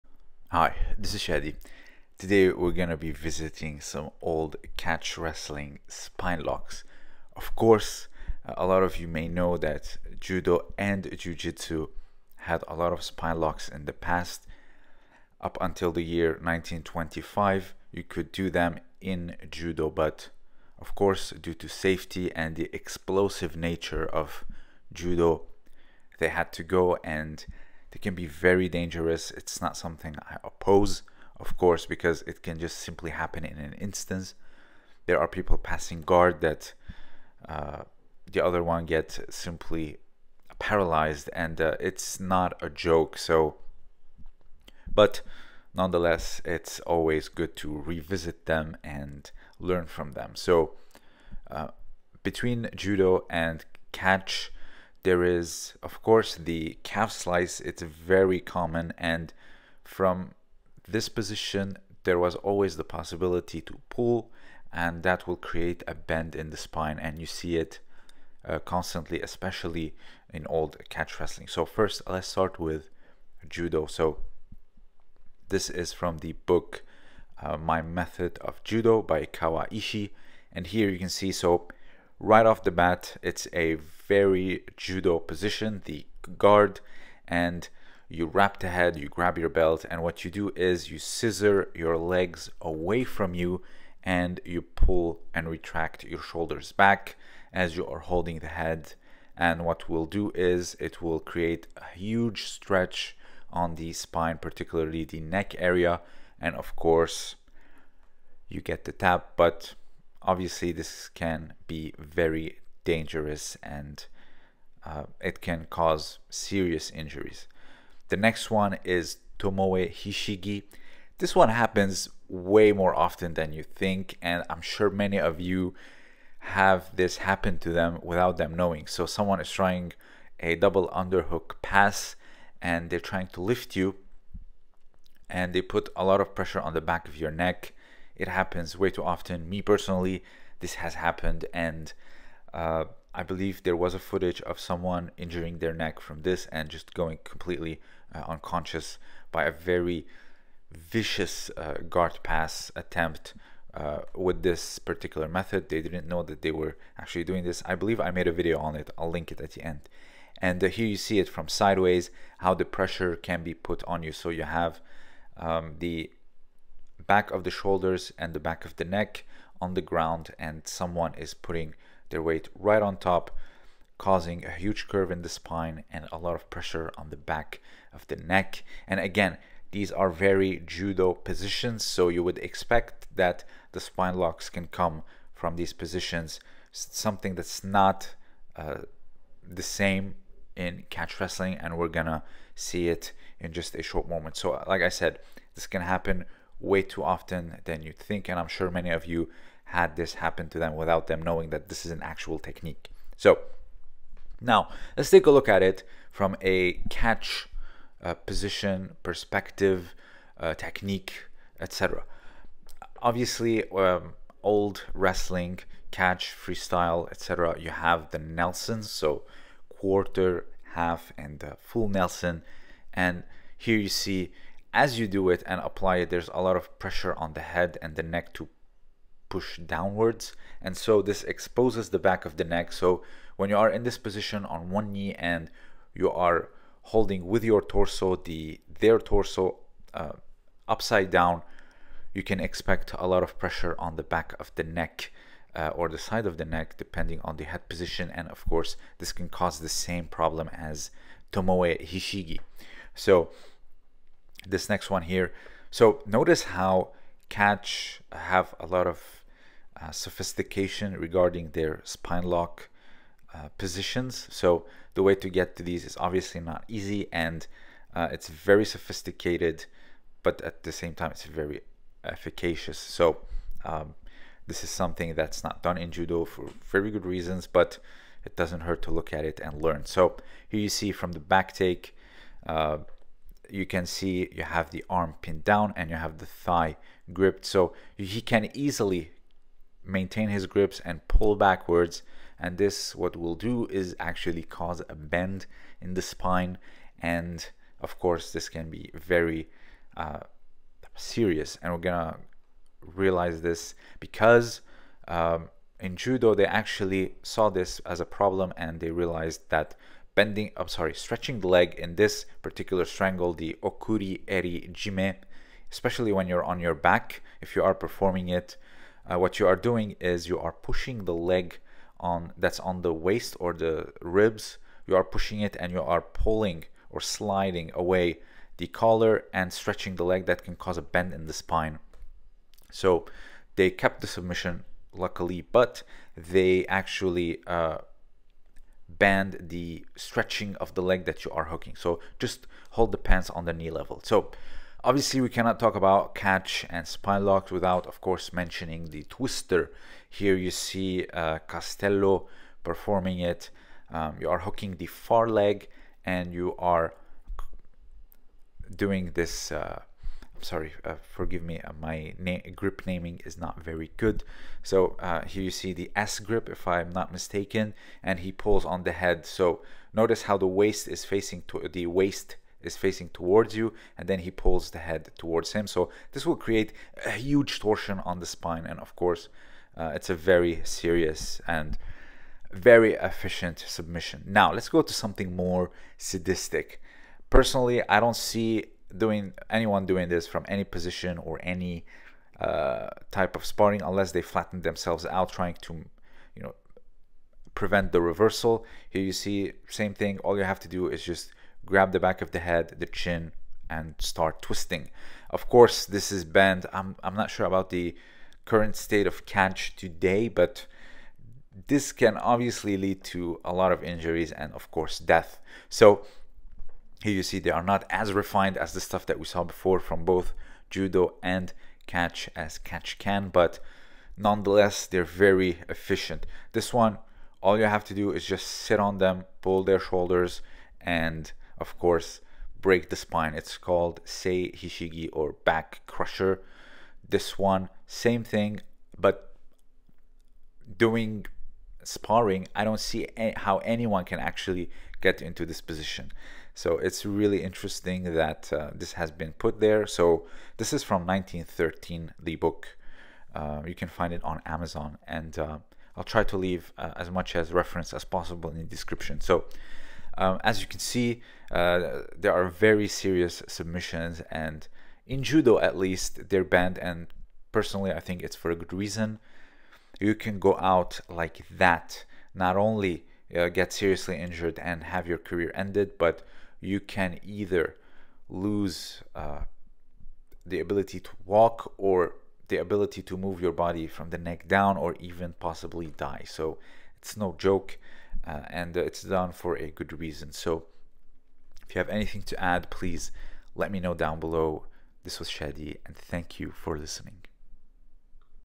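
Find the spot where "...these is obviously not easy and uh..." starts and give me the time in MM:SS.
04:25.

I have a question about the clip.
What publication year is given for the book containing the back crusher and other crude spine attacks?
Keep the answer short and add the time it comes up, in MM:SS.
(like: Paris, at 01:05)
1913, at 07:31.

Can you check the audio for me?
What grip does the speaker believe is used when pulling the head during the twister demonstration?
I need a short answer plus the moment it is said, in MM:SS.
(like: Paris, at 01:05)
S grip, at 06:05.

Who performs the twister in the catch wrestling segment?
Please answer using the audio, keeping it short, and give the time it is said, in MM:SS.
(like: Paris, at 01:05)
Castello, at 05:51.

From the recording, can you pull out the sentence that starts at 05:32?
So they kept the submission luckily, but they actually uh, bend the stretching of the leg that you are hooking.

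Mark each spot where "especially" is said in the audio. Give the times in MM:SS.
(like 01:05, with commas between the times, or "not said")
01:09, 05:15.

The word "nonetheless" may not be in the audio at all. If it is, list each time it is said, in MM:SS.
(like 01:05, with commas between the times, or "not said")
00:45, 07:04.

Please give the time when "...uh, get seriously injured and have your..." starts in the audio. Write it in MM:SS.
07:53.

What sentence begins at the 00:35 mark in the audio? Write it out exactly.
There are people passing guard that uh, the other one gets simply paralyzed, and uh, it's not a joke.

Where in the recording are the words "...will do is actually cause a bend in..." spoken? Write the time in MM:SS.
04:53.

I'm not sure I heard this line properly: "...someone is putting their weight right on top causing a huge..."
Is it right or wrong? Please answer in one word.
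right.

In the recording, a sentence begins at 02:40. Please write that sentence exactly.
And uh, here you see it from sideways, how the pressure can be put on you.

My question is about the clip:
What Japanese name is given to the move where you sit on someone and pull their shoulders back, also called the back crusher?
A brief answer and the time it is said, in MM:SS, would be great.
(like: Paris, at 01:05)
Sei Hishigi, at 07:14.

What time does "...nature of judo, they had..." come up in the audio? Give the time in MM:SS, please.
00:23.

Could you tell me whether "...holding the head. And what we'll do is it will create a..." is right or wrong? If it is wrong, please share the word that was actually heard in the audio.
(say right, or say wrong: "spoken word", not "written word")
right.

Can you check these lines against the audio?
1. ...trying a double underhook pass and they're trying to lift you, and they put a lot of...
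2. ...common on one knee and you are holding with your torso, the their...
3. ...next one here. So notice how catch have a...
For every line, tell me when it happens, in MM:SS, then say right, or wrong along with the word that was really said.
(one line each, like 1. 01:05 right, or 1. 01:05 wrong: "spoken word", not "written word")
1. 02:09 right
2. 03:53 wrong: "position", not "common"
3. 04:14 right.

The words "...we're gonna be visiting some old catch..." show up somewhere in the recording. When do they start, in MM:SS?
00:02.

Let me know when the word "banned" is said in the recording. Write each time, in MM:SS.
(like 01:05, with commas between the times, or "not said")
06:46, 07:46.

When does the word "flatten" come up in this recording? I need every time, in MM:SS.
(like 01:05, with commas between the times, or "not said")
06:34.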